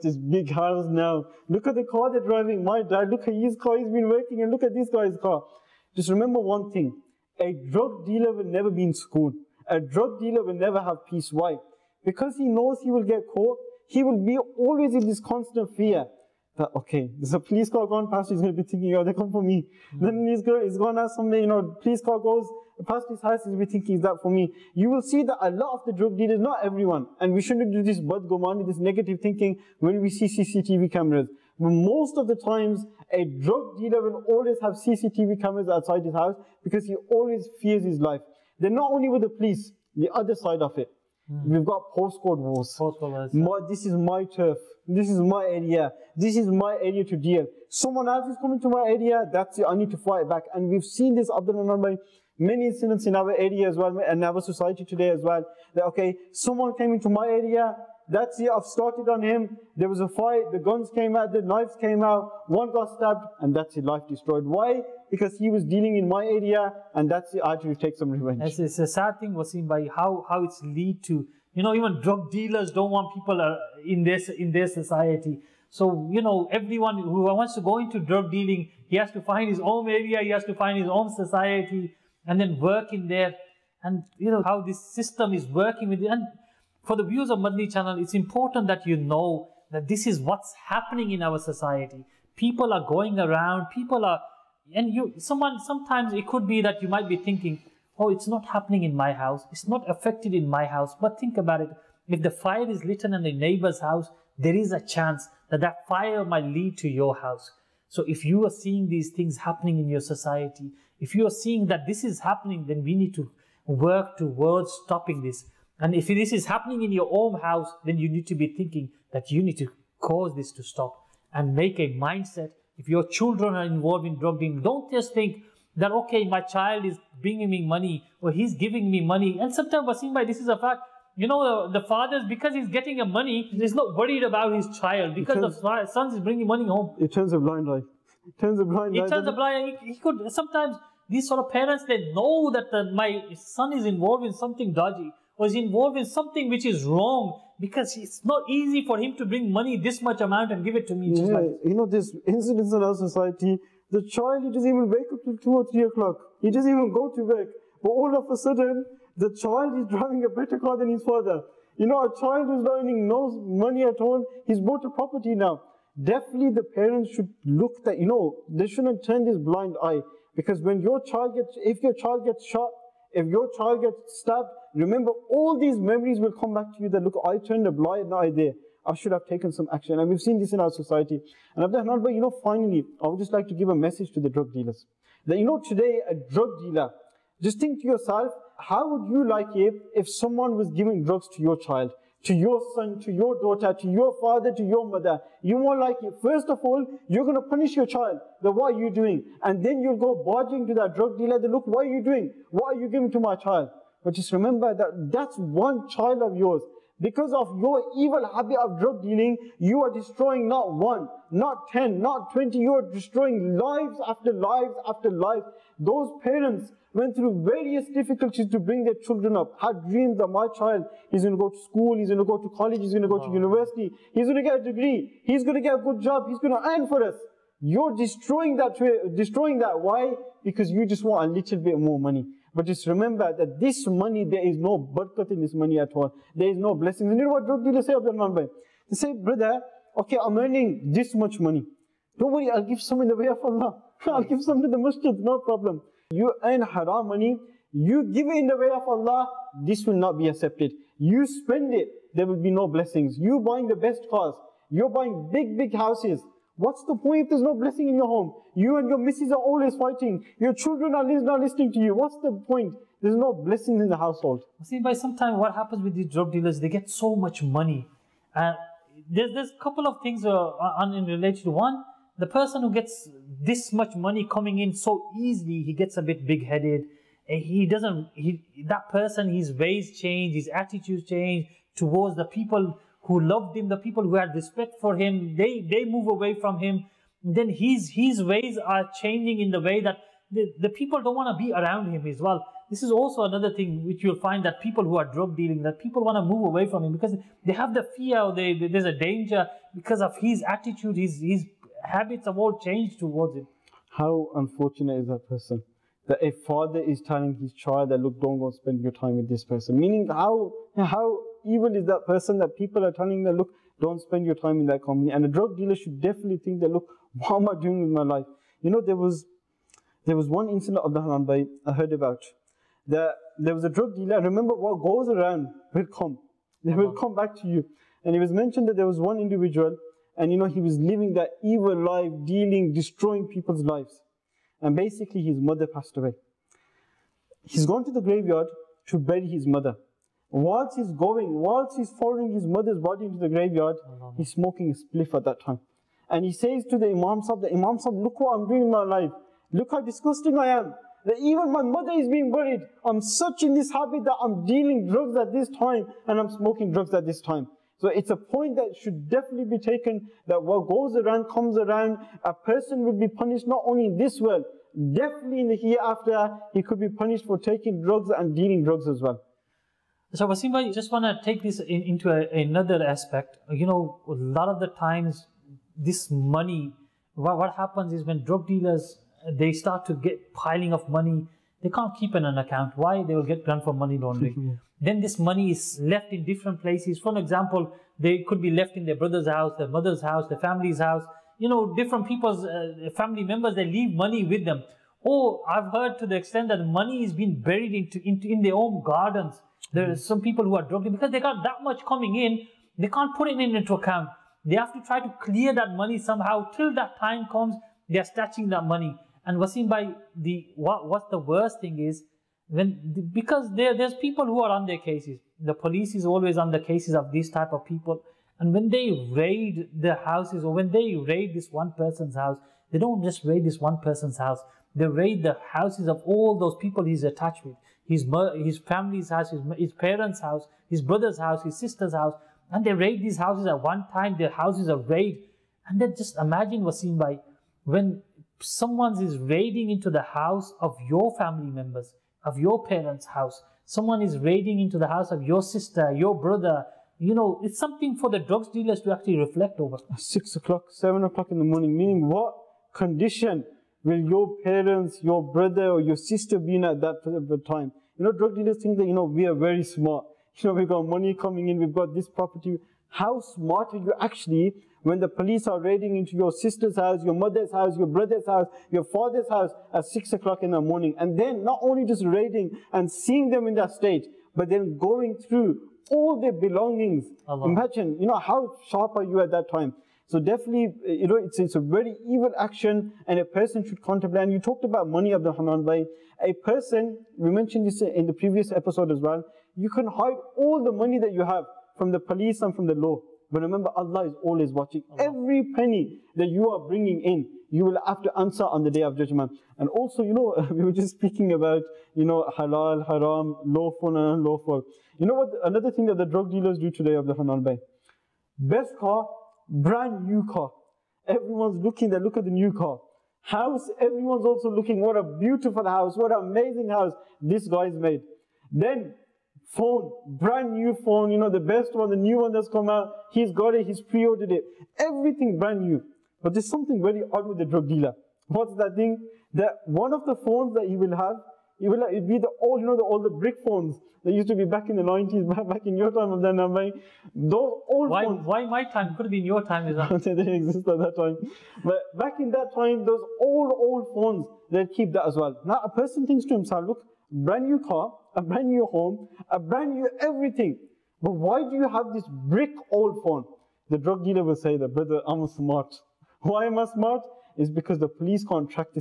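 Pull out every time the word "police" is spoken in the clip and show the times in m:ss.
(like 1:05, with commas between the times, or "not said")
0:17, 0:39, 6:55, 7:45, 8:11, 9:17.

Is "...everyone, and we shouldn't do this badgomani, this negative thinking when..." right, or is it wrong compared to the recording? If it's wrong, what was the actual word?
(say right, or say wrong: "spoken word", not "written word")
right.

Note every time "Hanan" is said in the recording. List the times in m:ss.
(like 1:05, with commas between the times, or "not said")
8:27.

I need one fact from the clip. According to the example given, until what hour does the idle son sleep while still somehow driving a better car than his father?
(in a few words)
2 or 3 o'clock.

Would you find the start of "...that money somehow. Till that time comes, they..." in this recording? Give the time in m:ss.
6:45.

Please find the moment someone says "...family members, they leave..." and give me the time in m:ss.
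6:32.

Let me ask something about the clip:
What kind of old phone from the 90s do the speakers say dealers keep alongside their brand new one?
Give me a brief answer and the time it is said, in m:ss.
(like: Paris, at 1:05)
Brick phones, at 8:53.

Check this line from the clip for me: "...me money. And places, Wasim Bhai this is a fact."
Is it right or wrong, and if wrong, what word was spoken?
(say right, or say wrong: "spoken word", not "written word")
wrong: "sometimes", not "places".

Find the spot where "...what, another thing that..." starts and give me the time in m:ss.
8:25.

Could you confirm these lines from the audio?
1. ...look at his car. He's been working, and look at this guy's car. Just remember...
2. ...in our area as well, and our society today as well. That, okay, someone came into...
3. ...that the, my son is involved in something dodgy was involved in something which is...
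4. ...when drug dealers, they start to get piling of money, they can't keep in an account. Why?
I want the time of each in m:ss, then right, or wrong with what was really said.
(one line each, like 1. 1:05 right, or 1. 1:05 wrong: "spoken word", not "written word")
1. 0:03 right
2. 0:53 right
3. 2:22 right
4. 6:18 right.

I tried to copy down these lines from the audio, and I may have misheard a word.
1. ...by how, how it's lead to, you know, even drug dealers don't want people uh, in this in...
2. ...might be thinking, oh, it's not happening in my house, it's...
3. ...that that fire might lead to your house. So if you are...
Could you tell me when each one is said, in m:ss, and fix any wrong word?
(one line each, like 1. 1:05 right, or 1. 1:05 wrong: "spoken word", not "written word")
1. 1:09 right
2. 1:36 right
3. 1:45 right.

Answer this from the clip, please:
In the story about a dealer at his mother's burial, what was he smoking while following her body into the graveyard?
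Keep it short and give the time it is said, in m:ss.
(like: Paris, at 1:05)
A spliff, at 5:44.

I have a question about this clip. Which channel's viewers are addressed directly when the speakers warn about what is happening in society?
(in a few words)
Madani channel.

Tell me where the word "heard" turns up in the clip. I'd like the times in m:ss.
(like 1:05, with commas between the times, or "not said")
5:21, 6:35.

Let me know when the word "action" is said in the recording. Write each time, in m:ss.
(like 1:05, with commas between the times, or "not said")
2:59, 8:02.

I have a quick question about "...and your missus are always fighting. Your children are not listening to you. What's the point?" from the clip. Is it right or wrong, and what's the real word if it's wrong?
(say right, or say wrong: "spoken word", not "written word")
right.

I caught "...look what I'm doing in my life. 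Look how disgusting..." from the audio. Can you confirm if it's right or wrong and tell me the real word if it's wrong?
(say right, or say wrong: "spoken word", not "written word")
right.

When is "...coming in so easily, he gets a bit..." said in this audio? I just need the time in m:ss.
4:34.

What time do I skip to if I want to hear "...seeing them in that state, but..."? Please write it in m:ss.
7:52.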